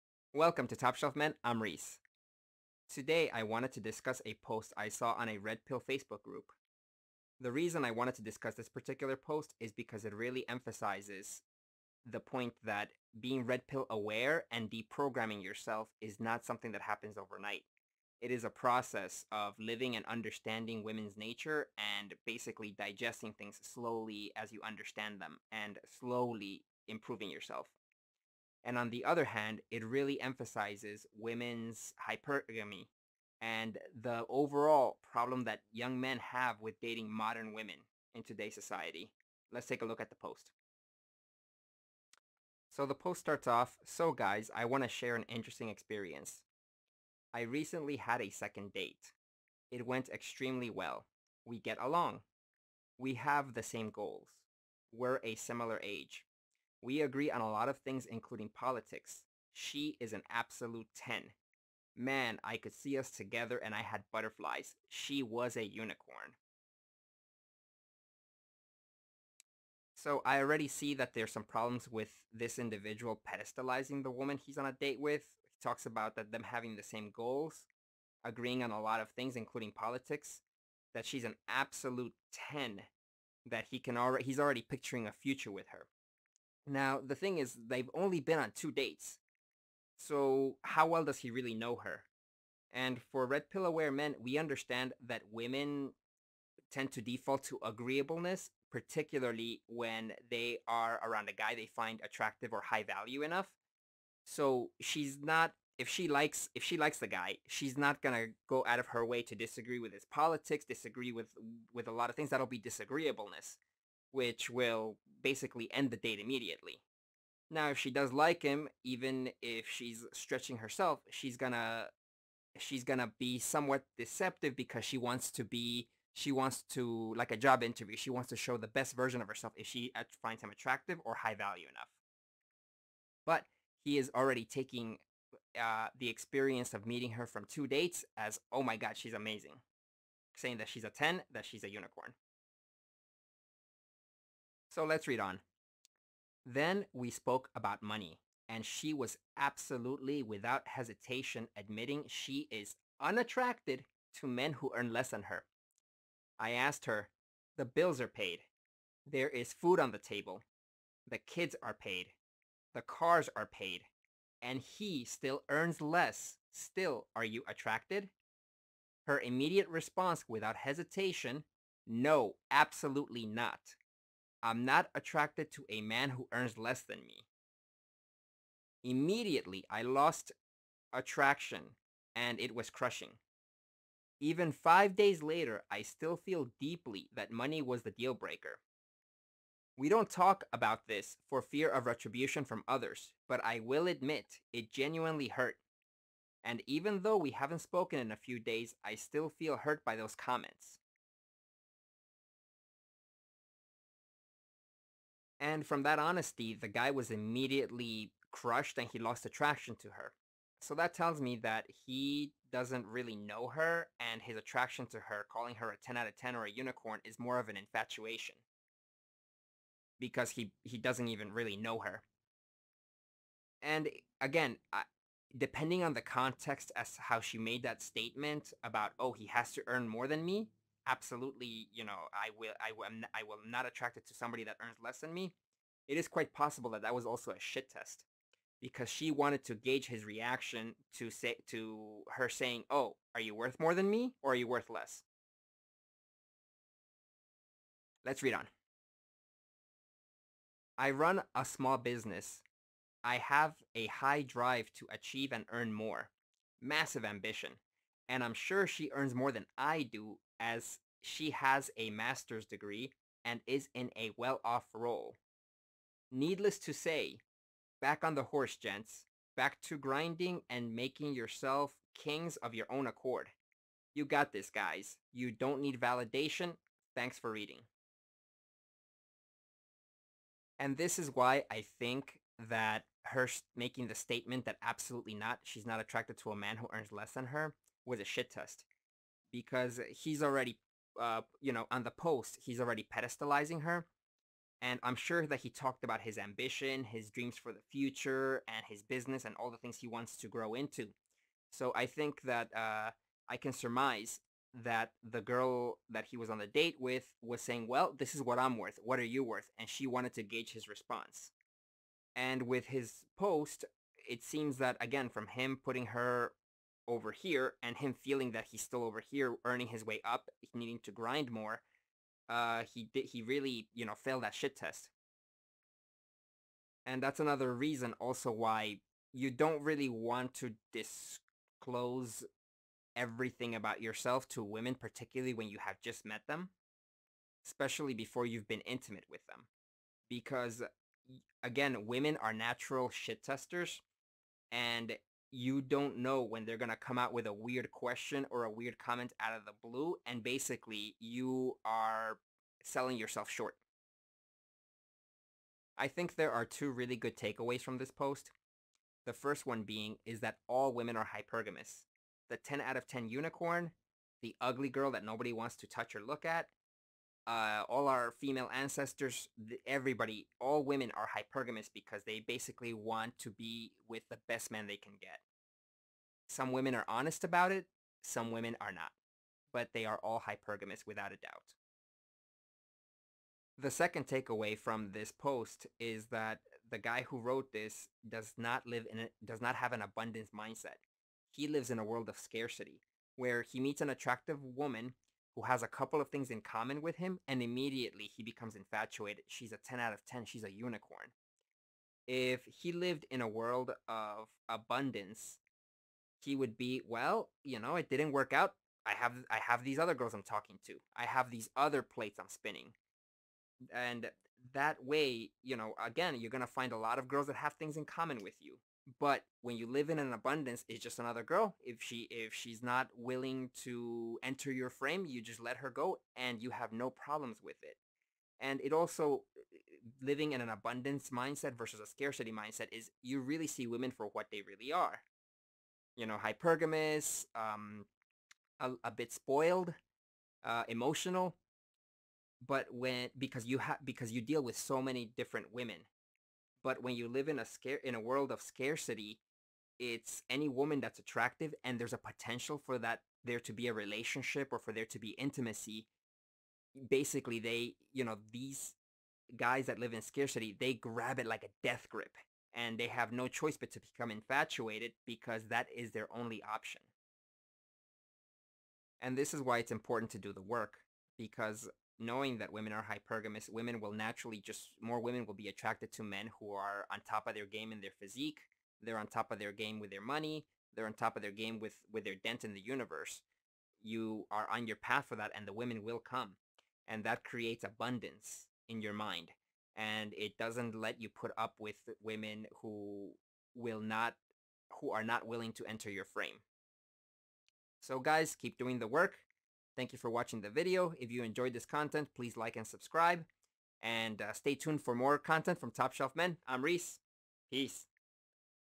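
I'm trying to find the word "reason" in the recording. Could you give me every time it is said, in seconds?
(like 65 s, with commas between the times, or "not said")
7 s, 327 s.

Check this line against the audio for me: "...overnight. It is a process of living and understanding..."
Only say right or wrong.
right.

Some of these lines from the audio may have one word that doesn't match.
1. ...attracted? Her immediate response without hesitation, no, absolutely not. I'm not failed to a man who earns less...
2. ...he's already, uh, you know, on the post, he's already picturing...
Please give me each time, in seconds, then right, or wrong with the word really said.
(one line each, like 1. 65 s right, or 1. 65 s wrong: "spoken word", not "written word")
1. 167 s wrong: "attracted", not "failed"
2. 289 s wrong: "pedestalizing", not "picturing".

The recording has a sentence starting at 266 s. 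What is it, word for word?
Needless to say, back on the horse, gents, back to grinding and making yourself kings of your own accord.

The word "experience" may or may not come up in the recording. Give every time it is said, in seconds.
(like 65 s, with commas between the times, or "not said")
45 s, 136 s.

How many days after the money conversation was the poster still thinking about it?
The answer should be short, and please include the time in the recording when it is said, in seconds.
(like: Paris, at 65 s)
5, at 184 s.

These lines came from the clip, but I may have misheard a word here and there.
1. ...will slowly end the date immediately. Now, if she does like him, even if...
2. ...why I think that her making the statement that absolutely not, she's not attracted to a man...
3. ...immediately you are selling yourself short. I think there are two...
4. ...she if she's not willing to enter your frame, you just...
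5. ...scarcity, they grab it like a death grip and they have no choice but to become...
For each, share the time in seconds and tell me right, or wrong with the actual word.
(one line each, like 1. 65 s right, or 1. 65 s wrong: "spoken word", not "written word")
1. 114 s wrong: "basically", not "slowly"
2. 281 s right
3. 350 s wrong: "basically", not "immediately"
4. 421 s right
5. 460 s right.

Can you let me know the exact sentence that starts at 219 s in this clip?
Because he, he doesn't even really know her.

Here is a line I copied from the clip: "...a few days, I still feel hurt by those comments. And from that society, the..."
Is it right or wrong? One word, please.
wrong.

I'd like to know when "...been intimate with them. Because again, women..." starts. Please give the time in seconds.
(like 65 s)
338 s.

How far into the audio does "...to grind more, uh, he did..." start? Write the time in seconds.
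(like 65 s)
320 s.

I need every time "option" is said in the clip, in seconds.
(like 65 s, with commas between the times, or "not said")
466 s.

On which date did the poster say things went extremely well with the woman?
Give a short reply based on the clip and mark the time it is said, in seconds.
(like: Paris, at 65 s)
Second date, at 48 s.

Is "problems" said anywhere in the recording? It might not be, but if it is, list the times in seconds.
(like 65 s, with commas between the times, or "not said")
35 s, 71 s, 426 s.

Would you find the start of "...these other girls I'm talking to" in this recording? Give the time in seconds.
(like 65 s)
409 s.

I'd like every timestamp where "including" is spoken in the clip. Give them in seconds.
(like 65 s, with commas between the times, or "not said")
58 s, 79 s.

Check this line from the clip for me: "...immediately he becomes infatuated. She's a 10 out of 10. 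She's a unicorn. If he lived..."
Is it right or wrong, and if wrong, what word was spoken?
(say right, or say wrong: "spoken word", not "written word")
right.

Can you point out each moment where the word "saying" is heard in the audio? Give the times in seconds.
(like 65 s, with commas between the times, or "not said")
140 s, 242 s, 307 s.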